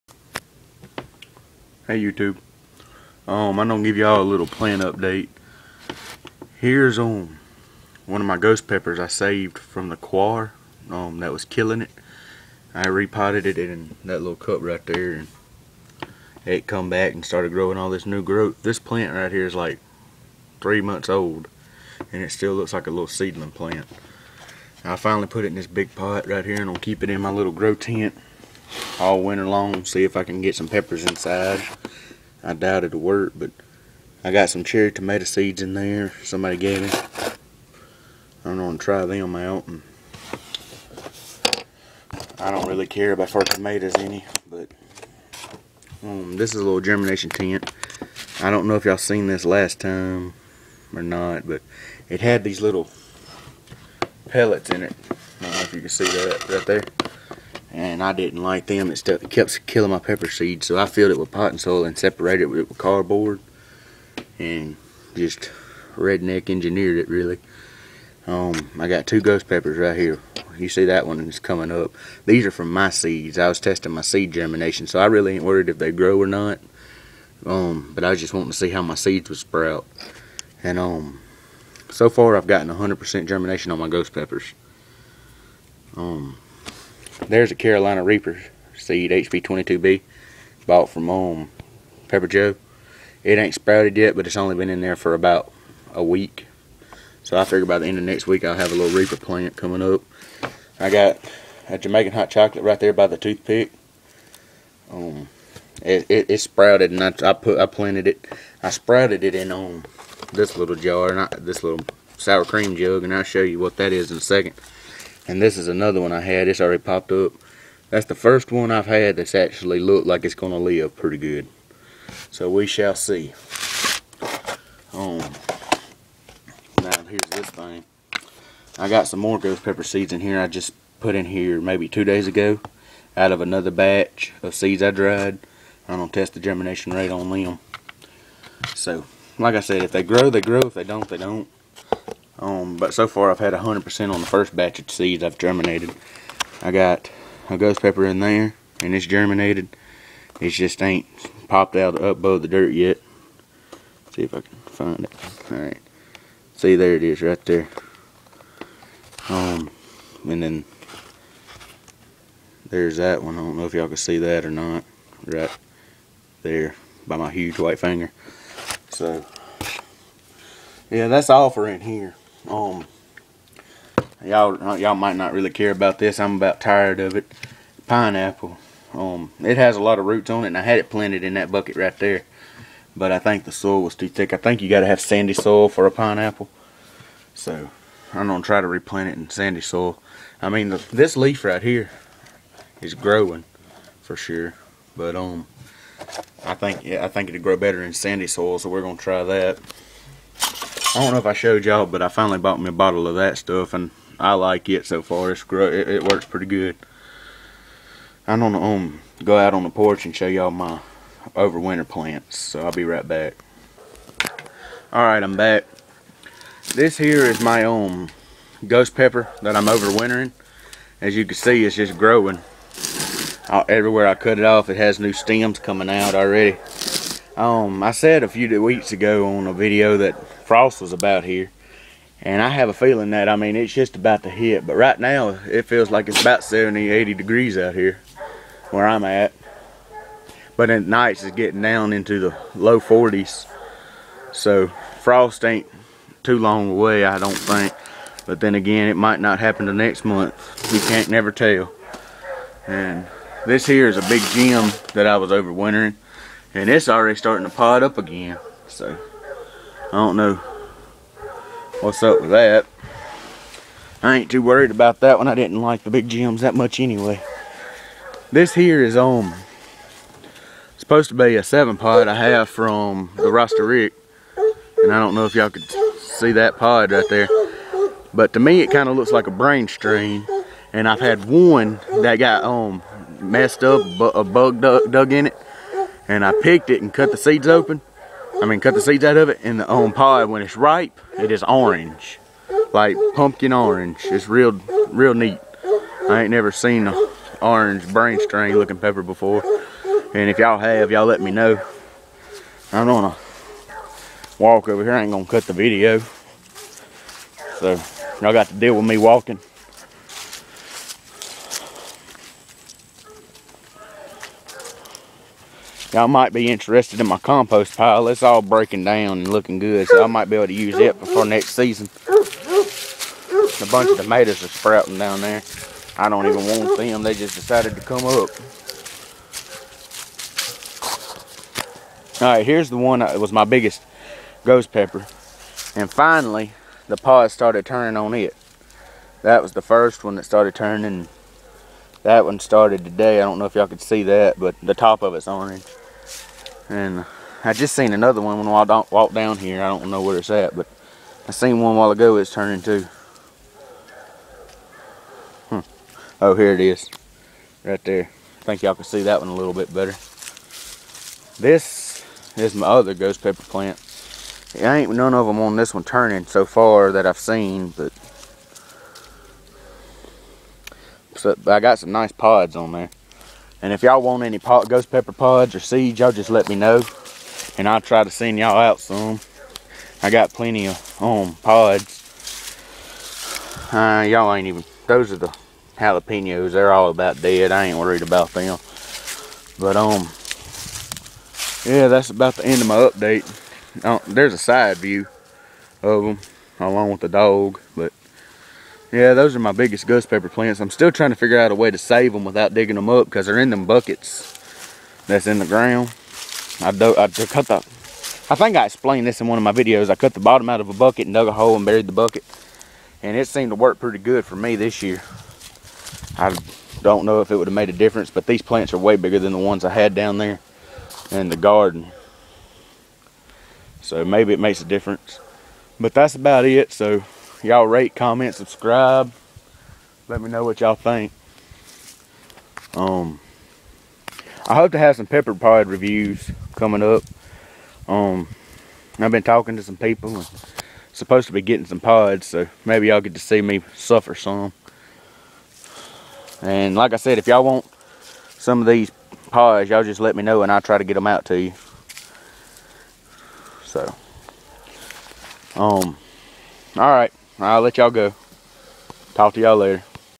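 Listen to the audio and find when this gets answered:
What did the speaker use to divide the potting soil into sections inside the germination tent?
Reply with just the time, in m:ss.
1:02.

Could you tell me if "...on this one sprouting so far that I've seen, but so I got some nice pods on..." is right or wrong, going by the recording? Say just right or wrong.
wrong.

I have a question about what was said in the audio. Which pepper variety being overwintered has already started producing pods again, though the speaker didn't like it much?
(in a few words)
Big Jim.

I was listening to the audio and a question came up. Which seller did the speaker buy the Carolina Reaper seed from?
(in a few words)
Pepper Joe.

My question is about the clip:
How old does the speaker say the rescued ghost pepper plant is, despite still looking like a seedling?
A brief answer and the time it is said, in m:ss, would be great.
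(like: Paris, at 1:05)
3 months, at 0:20.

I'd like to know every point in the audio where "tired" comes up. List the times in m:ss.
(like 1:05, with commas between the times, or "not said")
2:56.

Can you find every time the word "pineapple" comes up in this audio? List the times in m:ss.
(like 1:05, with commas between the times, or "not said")
2:57, 3:05.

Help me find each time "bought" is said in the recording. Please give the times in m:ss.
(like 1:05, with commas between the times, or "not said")
1:30, 3:22.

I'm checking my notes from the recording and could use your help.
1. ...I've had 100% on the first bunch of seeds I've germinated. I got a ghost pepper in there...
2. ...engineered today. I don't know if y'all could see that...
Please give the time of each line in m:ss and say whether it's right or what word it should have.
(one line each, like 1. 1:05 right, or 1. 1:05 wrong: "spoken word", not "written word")
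1. 2:23 wrong: "batch", not "bunch"
2. 5:42 wrong: "started", not "engineered".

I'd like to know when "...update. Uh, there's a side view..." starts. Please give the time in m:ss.
6:32.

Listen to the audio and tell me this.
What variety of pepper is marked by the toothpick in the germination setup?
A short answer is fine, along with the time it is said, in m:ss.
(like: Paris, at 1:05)
Jamaican hot chocolate, at 1:41.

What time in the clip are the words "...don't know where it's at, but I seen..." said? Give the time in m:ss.
5:49.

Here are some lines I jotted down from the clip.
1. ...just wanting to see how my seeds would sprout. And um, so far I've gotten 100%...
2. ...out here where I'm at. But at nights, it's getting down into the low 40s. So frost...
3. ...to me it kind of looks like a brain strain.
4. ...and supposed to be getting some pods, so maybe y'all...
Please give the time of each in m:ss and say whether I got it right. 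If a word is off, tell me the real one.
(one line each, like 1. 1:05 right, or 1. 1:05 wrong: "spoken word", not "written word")
1. 1:18 right
2. 3:57 right
3. 4:38 right
4. 7:20 right.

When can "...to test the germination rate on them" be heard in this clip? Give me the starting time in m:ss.
2:16.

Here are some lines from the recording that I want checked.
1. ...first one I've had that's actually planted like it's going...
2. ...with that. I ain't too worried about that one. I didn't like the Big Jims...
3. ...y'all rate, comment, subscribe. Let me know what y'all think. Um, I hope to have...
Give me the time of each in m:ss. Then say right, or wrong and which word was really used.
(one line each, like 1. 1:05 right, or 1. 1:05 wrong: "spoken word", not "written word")
1. 1:58 wrong: "looked", not "planted"
2. 4:22 right
3. 7:07 right.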